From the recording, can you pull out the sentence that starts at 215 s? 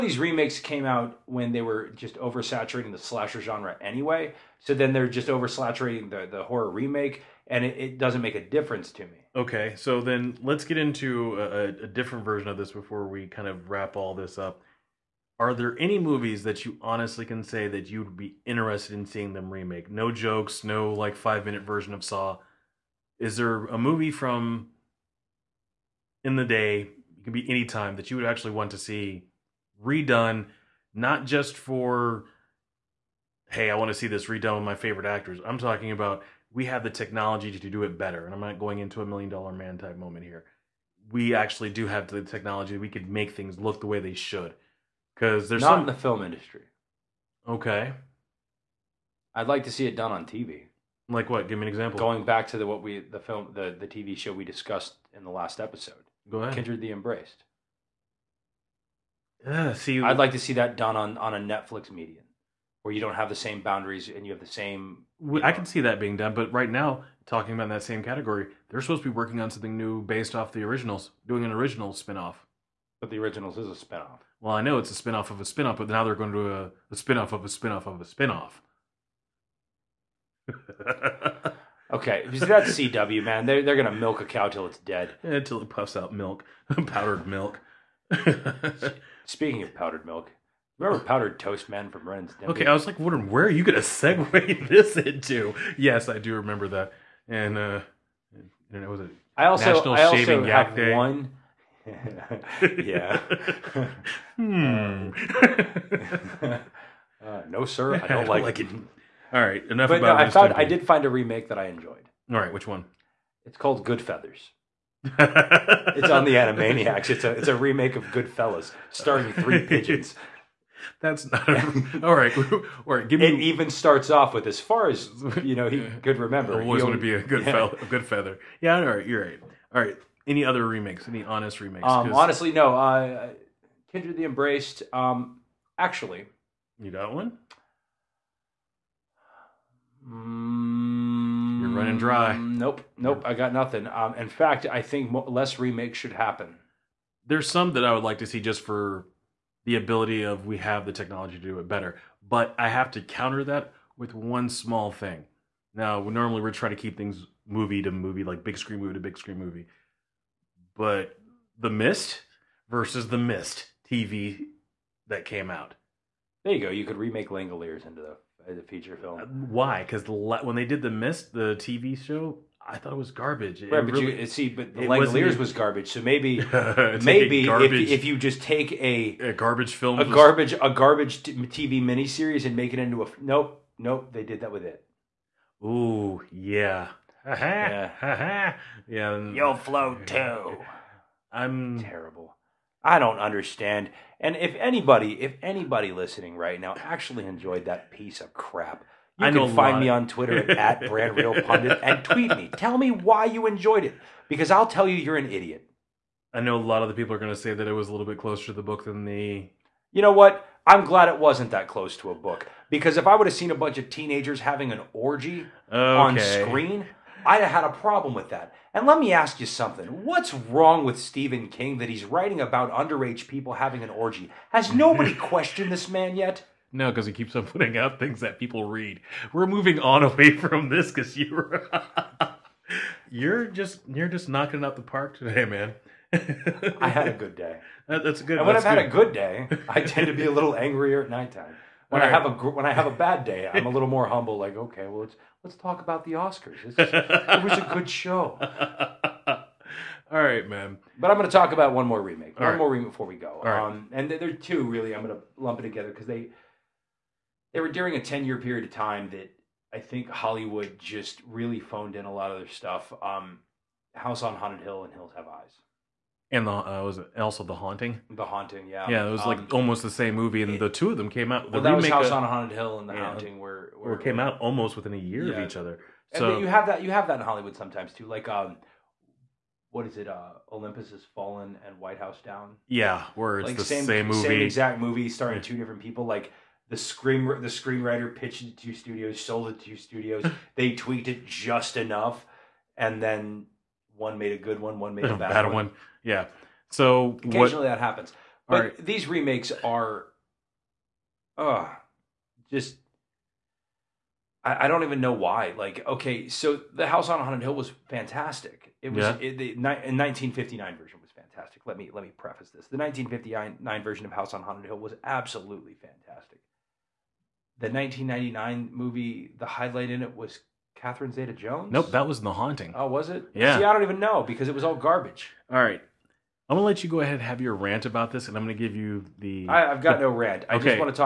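on screen, I had a problem with that.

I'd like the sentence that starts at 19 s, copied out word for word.
No jokes, no like five minute version of Saw.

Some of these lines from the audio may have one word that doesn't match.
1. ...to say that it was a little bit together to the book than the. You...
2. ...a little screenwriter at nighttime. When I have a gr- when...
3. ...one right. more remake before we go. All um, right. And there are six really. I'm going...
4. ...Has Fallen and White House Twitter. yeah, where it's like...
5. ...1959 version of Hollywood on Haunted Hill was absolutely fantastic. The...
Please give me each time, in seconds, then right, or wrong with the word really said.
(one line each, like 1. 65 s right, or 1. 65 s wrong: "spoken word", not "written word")
1. 207 s wrong: "closer", not "together"
2. 240 s wrong: "angrier", not "screenwriter"
3. 252 s wrong: "two", not "six"
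4. 280 s wrong: "Down", not "Twitter"
5. 312 s wrong: "House", not "Hollywood".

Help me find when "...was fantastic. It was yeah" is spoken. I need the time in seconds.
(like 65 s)
307 s.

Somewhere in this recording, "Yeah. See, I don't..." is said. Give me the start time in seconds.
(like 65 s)
323 s.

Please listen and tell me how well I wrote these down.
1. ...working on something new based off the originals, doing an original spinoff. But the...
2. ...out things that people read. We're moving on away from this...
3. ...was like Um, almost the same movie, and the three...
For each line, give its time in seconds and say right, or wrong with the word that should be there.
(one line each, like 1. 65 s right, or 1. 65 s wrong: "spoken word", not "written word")
1. 69 s right
2. 227 s right
3. 269 s wrong: "two", not "three".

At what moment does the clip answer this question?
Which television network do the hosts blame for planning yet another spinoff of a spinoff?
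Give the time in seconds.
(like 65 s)
82 s.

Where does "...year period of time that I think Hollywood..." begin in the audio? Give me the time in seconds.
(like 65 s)
258 s.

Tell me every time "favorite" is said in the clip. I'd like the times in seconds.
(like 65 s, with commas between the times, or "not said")
34 s.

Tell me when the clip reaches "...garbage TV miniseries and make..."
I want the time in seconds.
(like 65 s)
180 s.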